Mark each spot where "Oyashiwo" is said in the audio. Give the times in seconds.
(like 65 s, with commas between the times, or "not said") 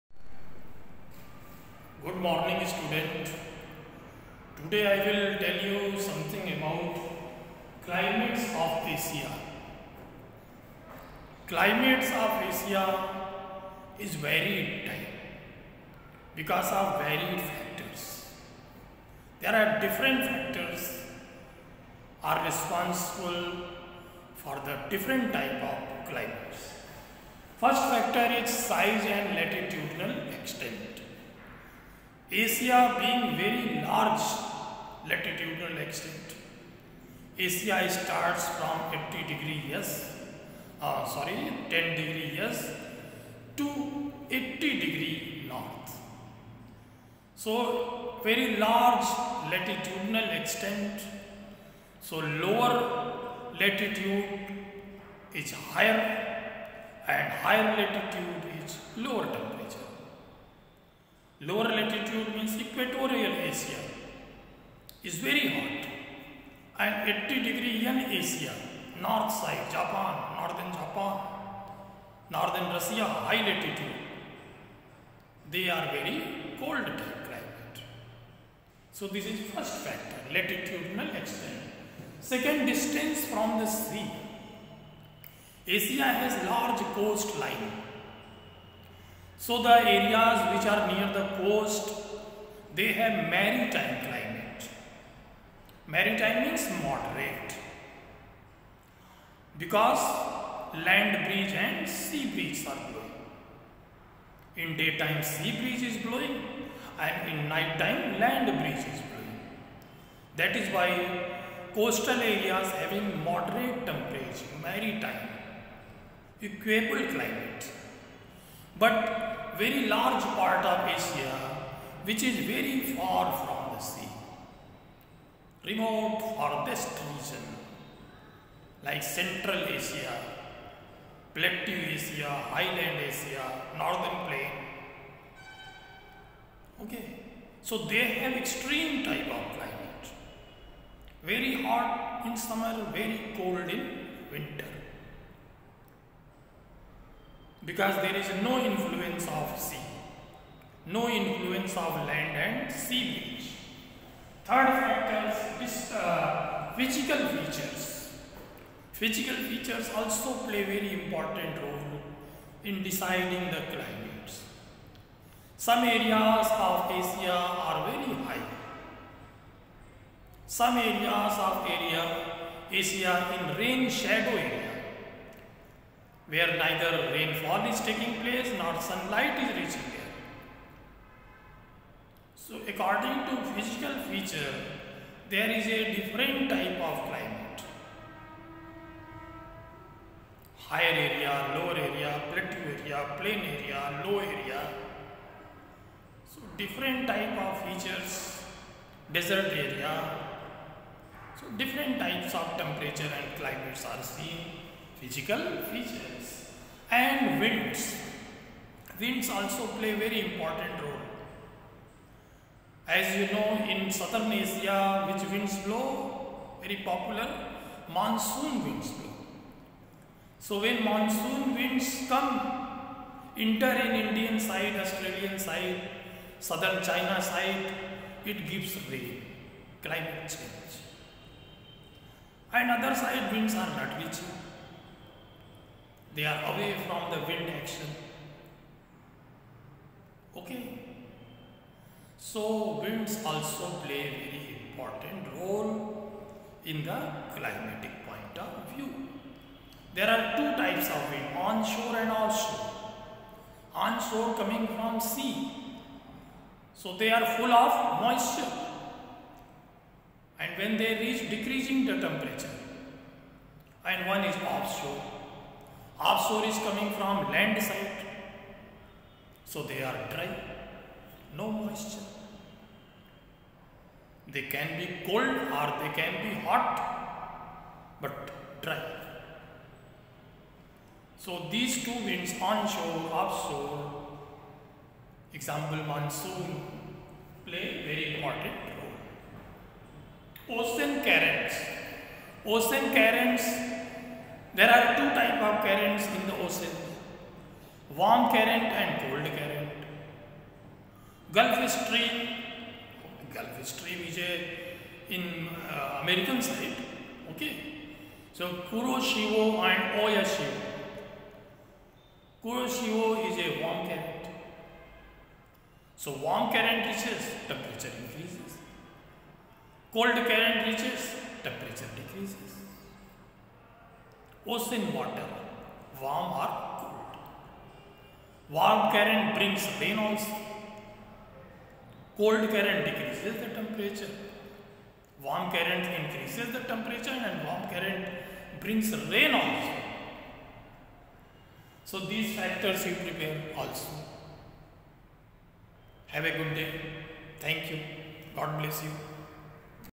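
310 s.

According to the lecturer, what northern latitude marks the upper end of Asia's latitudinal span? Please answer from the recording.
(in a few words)
80 degree north.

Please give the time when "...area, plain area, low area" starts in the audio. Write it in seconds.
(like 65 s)
192 s.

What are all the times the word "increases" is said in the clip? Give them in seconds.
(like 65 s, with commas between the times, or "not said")
318 s, 335 s.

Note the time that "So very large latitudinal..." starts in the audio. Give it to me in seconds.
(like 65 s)
47 s.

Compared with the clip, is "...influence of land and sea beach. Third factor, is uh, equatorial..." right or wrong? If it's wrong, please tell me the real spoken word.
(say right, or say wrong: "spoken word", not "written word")
wrong: "physical", not "equatorial".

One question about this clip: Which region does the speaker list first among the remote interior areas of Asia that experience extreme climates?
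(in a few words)
Central Asia.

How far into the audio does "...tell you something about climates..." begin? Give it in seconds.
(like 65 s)
5 s.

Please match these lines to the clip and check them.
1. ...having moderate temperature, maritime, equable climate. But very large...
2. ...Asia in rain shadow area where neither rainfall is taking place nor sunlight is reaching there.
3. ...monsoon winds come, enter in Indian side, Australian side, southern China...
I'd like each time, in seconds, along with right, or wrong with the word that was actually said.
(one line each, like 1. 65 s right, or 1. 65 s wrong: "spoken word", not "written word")
1. 112 s right
2. 172 s right
3. 220 s right.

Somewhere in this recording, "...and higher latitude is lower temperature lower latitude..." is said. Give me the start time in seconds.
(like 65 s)
57 s.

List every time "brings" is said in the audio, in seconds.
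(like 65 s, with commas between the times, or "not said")
329 s, 338 s.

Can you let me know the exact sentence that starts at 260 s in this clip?
And when they reach decreasing the temperature, and one is offshore Offshore is coming from land side.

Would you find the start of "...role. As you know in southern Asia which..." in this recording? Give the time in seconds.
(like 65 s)
210 s.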